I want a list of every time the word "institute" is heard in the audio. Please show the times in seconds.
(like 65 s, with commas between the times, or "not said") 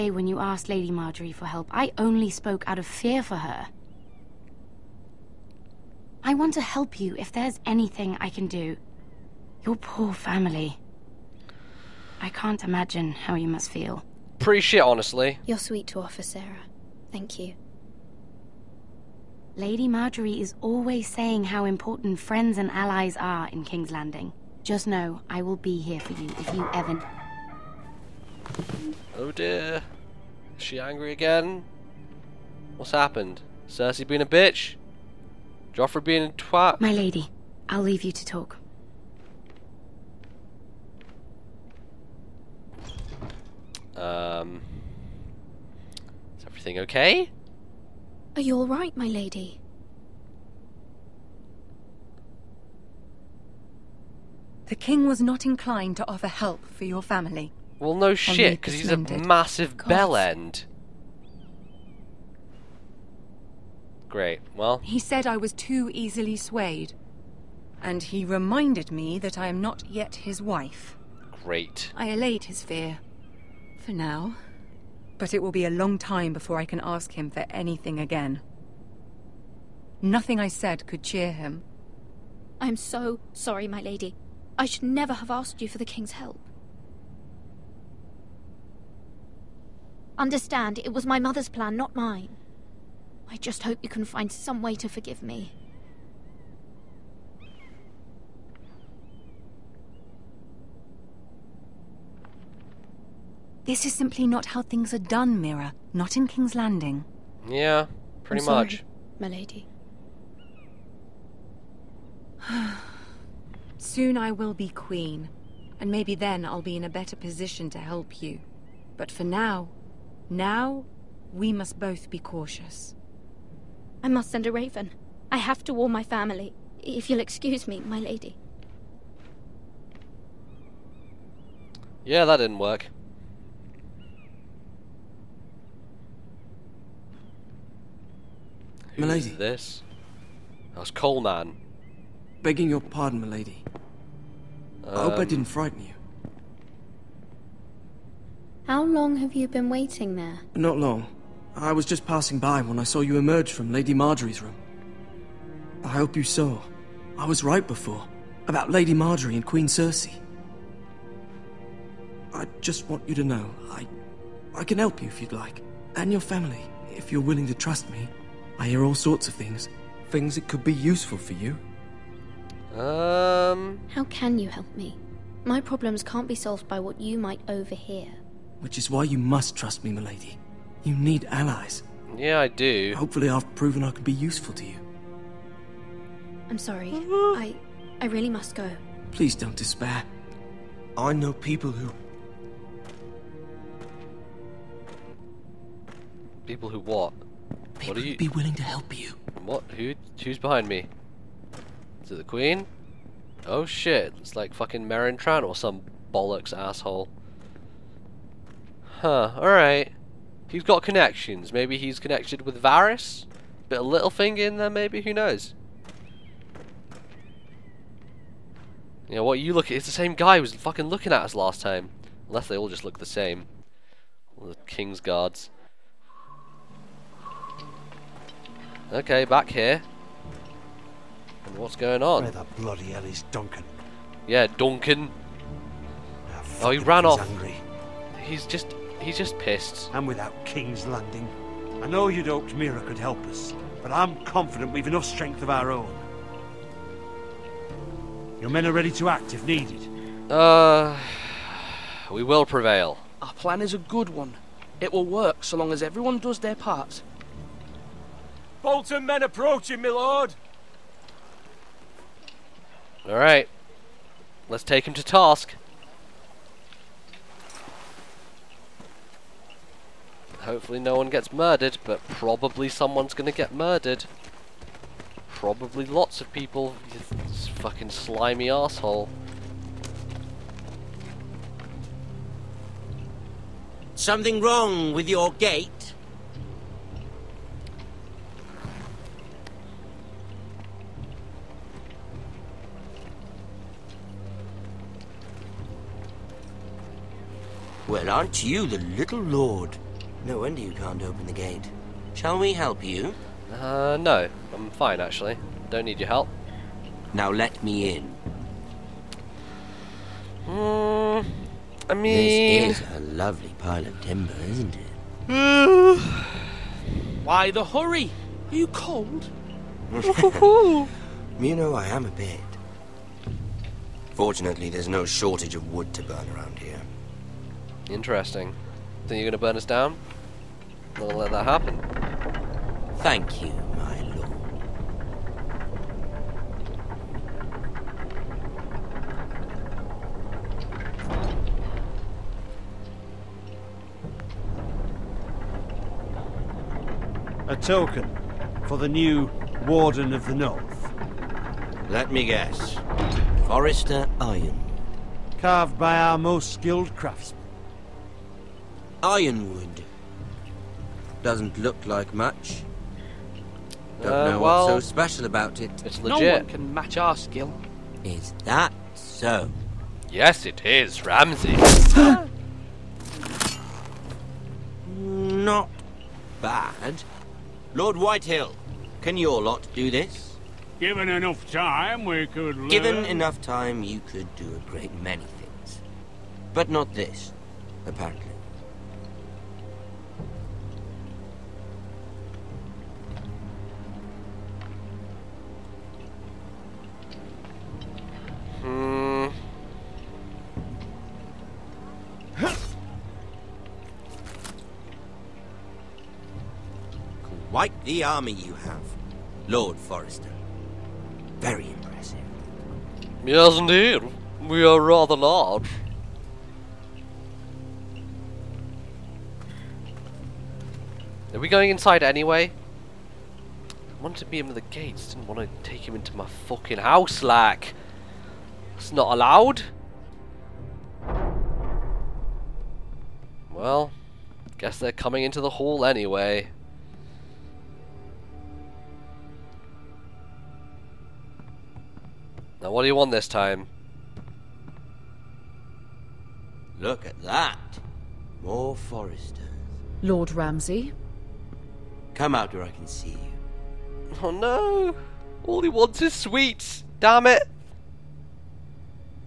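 not said.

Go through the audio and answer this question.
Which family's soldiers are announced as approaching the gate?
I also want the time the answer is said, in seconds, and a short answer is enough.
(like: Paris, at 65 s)
Bolton, at 258 s.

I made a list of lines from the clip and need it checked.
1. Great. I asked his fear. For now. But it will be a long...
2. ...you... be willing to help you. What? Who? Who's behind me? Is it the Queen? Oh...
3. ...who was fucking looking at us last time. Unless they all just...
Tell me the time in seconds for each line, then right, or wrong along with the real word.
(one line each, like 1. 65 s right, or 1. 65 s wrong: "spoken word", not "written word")
1. 71 s wrong: "allayed", not "asked"
2. 198 s right
3. 220 s right.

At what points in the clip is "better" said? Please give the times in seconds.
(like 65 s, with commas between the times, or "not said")
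116 s.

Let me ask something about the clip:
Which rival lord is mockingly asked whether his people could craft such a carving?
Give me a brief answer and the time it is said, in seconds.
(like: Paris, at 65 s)
Lord Whitehill, at 377 s.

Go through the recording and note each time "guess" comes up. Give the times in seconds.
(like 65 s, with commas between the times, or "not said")
352 s, 434 s.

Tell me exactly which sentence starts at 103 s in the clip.
This is simply not how things are done, Mira.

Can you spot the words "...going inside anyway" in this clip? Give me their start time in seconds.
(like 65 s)
421 s.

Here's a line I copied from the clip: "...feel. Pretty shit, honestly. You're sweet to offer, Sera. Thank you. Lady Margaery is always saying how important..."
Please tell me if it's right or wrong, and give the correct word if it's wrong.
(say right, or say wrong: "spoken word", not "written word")
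right.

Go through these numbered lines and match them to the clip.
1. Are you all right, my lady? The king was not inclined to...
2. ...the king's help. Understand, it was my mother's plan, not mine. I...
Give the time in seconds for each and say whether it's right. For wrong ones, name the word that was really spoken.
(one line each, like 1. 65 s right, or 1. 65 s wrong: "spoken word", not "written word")
1. 48 s right
2. 85 s right.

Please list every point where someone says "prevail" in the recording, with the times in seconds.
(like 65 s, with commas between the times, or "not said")
252 s.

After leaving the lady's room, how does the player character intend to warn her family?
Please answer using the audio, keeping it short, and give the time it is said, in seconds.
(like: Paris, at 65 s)
Send a raven, at 124 s.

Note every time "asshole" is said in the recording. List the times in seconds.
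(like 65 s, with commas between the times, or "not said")
206 s, 278 s.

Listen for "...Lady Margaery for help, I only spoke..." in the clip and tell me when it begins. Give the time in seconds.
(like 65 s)
0 s.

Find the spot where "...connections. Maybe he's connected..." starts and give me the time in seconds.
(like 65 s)
210 s.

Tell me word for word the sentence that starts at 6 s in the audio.
I want to help you if there's anything I can do.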